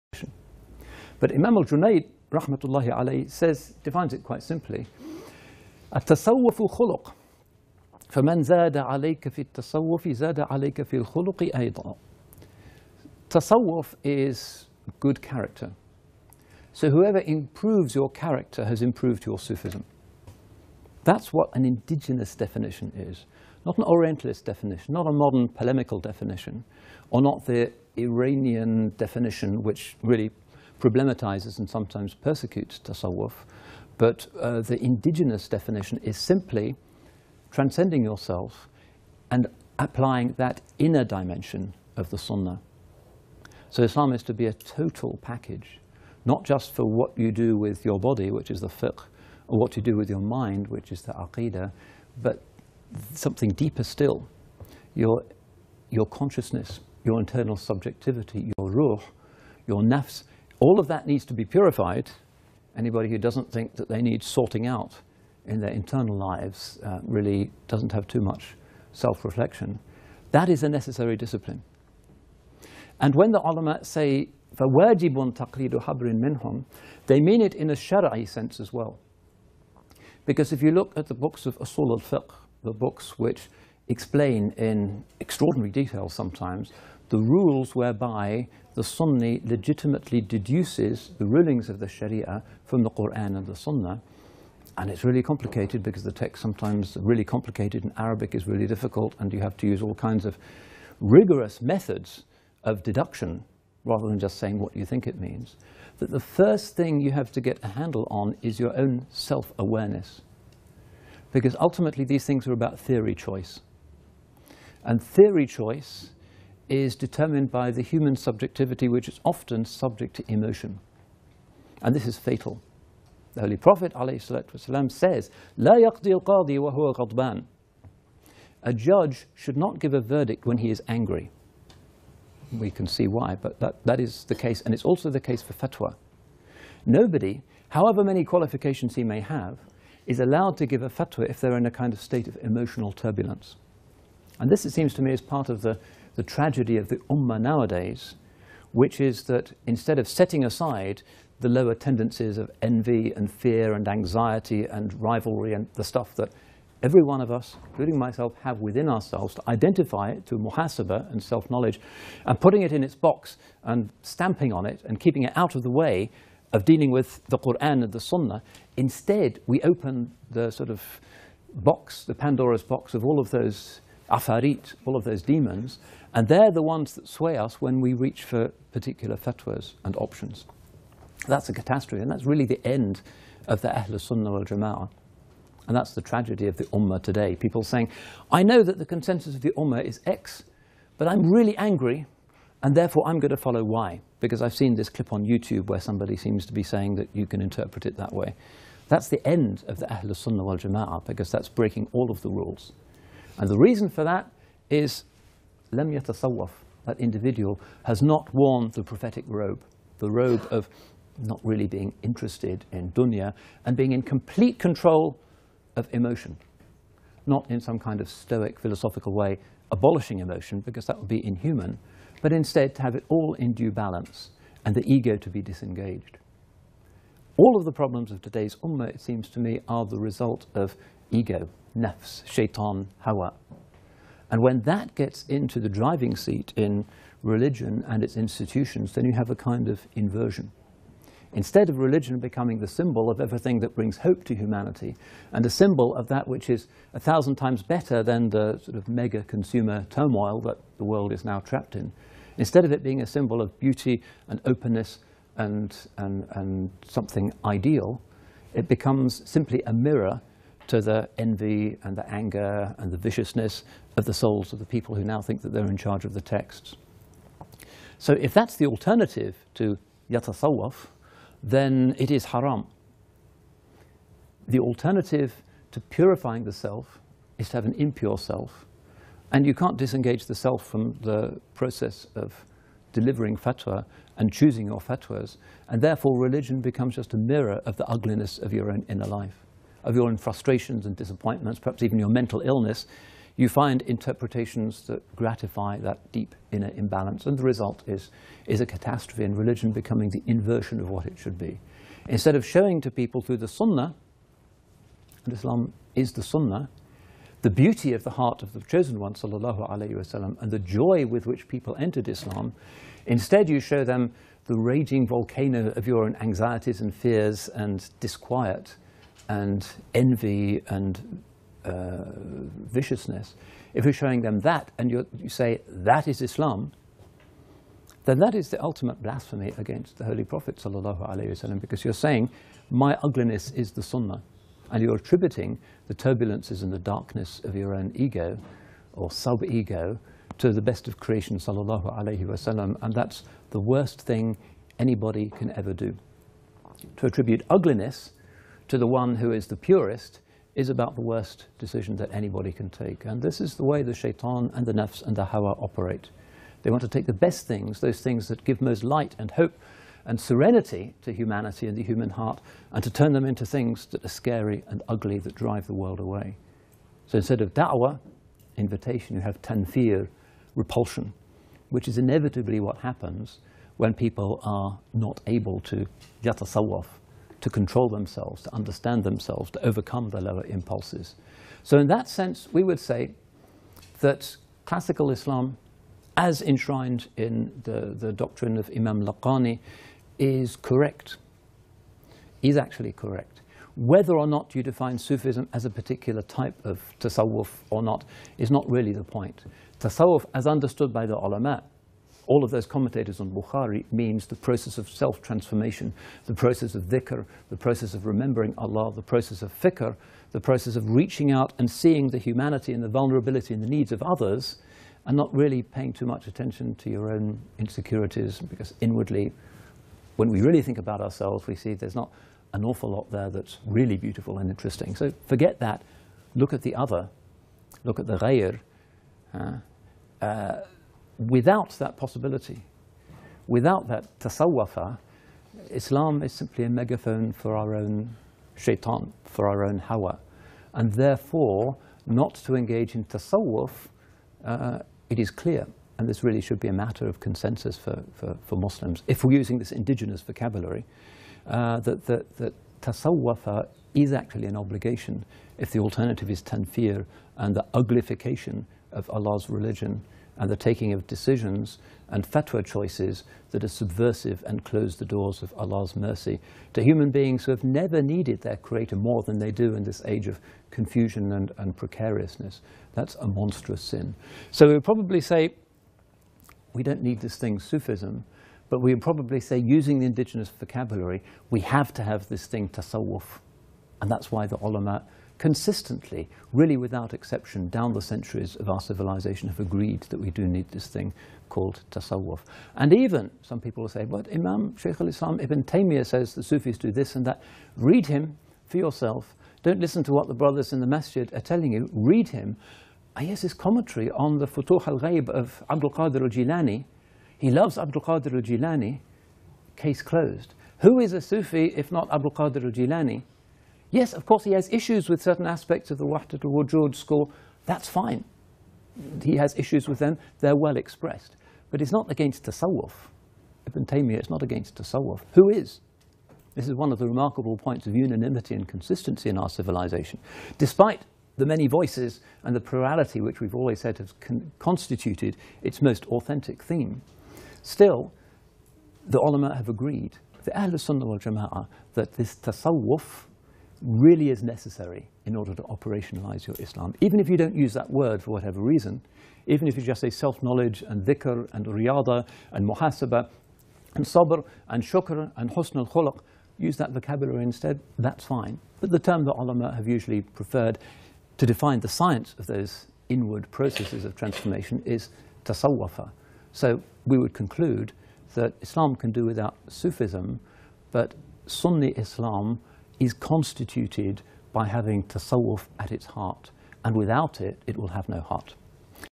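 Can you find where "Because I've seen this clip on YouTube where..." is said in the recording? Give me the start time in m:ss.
3:14.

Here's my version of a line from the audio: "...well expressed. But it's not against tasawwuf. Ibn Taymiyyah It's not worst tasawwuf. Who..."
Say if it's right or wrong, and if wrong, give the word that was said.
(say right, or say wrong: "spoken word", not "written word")
wrong: "against", not "worst".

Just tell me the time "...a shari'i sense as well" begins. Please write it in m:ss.
1:17.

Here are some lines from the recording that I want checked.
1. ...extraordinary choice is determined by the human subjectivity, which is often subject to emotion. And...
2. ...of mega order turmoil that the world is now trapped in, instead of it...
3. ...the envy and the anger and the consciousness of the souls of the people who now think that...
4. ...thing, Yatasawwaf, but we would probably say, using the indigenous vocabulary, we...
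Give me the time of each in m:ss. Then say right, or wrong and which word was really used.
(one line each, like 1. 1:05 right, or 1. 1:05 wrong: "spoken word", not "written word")
1. 1:55 wrong: "theory", not "extraordinary"
2. 4:08 wrong: "consumer", not "order"
3. 4:20 wrong: "viciousness", not "consciousness"
4. 7:57 wrong: "Sufism", not "Yatasawwaf".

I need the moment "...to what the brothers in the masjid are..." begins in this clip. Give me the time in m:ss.
8:20.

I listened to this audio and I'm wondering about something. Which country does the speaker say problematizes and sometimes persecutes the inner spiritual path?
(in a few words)
Iranian.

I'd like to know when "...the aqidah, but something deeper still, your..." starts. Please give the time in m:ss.
0:51.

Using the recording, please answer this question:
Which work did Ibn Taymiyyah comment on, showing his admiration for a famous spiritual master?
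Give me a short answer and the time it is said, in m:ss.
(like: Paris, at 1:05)
Futuh al-Ghaib, at 8:24.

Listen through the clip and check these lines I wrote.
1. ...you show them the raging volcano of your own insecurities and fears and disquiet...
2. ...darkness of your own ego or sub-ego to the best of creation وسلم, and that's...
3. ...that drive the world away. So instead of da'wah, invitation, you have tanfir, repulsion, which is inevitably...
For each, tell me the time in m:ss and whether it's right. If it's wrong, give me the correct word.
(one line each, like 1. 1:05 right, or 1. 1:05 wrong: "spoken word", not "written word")
1. 5:13 wrong: "anxieties", not "insecurities"
2. 5:36 right
3. 6:05 right.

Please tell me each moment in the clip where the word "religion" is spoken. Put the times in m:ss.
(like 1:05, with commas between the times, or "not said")
3:57, 4:01, 4:46, 4:59, 7:39.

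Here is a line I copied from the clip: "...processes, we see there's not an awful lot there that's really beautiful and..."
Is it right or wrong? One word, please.
wrong.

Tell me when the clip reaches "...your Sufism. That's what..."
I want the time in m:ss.
0:19.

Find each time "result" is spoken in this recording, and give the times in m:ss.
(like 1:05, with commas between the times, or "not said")
3:49, 4:57.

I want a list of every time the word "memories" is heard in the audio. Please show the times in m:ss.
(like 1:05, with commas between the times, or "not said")
not said.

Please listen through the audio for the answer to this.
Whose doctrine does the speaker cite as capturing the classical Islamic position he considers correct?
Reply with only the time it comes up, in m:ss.
6:28.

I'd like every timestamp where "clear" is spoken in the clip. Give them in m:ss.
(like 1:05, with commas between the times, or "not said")
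7:25.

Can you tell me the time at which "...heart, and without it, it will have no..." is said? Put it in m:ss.
9:36.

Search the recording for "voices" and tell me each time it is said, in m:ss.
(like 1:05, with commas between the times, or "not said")
8:51.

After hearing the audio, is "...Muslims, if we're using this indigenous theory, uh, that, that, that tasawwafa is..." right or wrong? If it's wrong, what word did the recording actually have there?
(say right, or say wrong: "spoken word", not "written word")
wrong: "vocabulary", not "theory".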